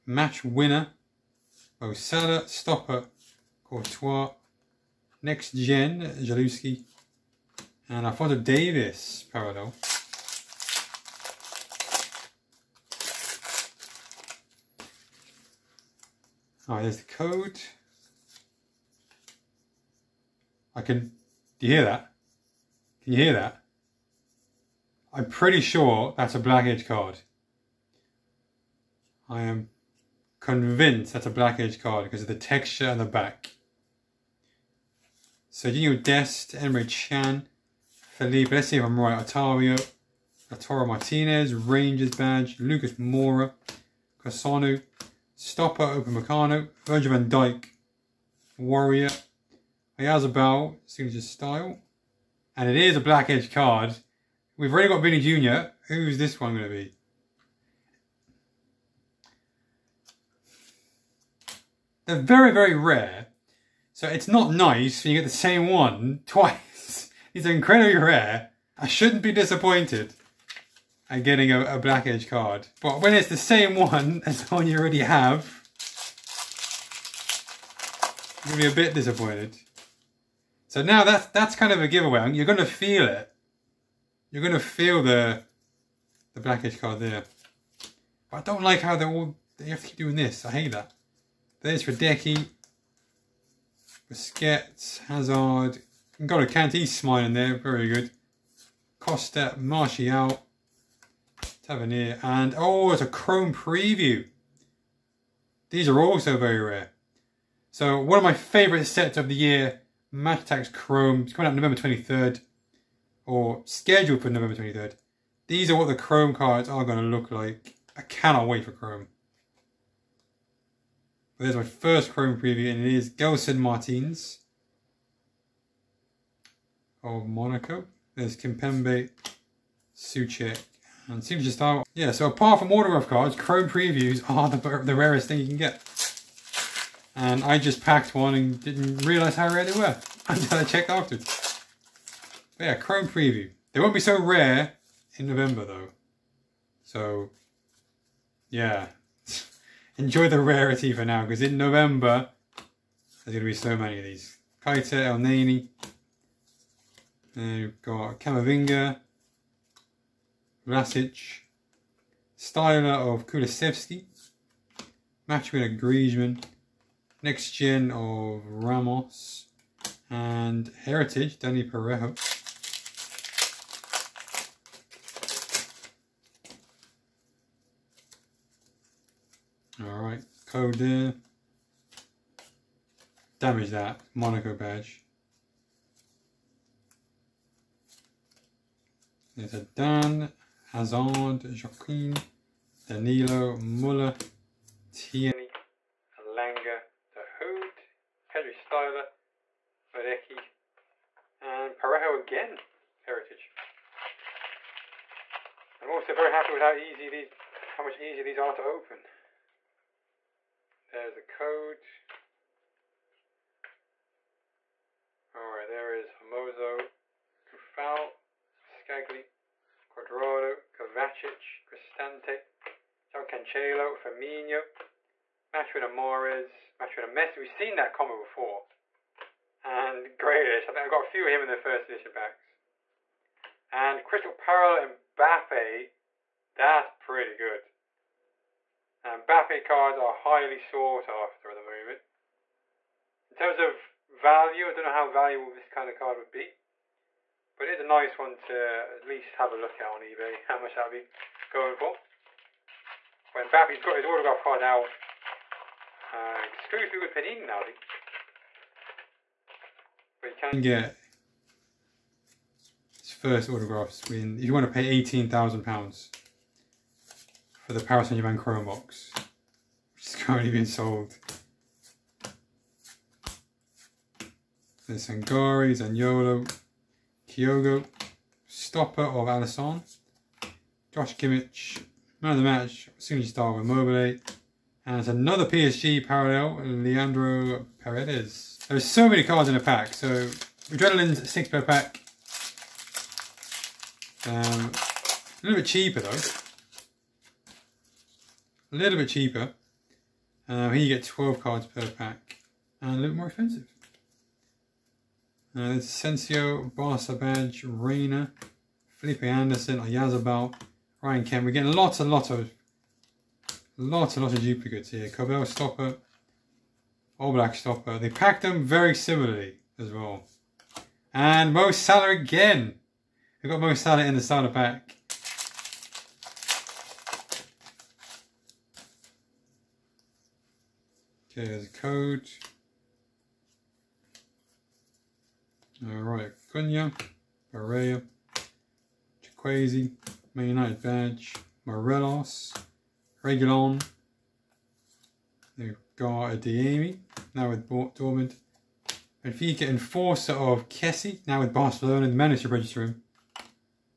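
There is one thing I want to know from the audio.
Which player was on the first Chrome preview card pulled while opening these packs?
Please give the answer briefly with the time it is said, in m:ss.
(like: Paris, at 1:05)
Gelson Martins, at 2:03.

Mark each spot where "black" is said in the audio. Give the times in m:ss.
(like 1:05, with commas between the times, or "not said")
0:26, 0:31, 0:53, 1:11, 1:26, 5:17.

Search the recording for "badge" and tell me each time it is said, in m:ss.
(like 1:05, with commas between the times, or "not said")
0:42, 3:04, 5:07, 5:40.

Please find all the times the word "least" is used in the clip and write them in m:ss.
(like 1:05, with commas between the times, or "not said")
4:09.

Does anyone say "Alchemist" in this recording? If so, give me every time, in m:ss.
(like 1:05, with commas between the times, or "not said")
not said.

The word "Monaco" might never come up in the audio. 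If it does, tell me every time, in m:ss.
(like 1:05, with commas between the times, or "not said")
2:07, 3:04.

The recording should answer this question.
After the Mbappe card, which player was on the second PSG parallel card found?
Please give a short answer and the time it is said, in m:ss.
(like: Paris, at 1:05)
Leandro Paredes, at 4:46.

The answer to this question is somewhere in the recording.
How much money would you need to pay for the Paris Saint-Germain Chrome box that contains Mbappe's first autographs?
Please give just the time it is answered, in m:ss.
4:25.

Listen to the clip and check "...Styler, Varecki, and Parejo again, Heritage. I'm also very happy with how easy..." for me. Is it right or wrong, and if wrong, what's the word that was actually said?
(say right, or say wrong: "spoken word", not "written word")
right.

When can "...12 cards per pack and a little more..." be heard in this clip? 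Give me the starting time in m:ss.
5:01.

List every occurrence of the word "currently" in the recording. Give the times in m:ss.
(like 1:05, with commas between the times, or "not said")
4:30.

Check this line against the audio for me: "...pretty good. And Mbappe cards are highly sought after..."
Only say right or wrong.
right.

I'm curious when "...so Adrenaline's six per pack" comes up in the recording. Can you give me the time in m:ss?
4:49.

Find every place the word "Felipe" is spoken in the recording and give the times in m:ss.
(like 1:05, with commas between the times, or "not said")
0:37, 5:08.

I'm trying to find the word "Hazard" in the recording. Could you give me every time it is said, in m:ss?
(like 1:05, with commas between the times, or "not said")
1:35, 3:10.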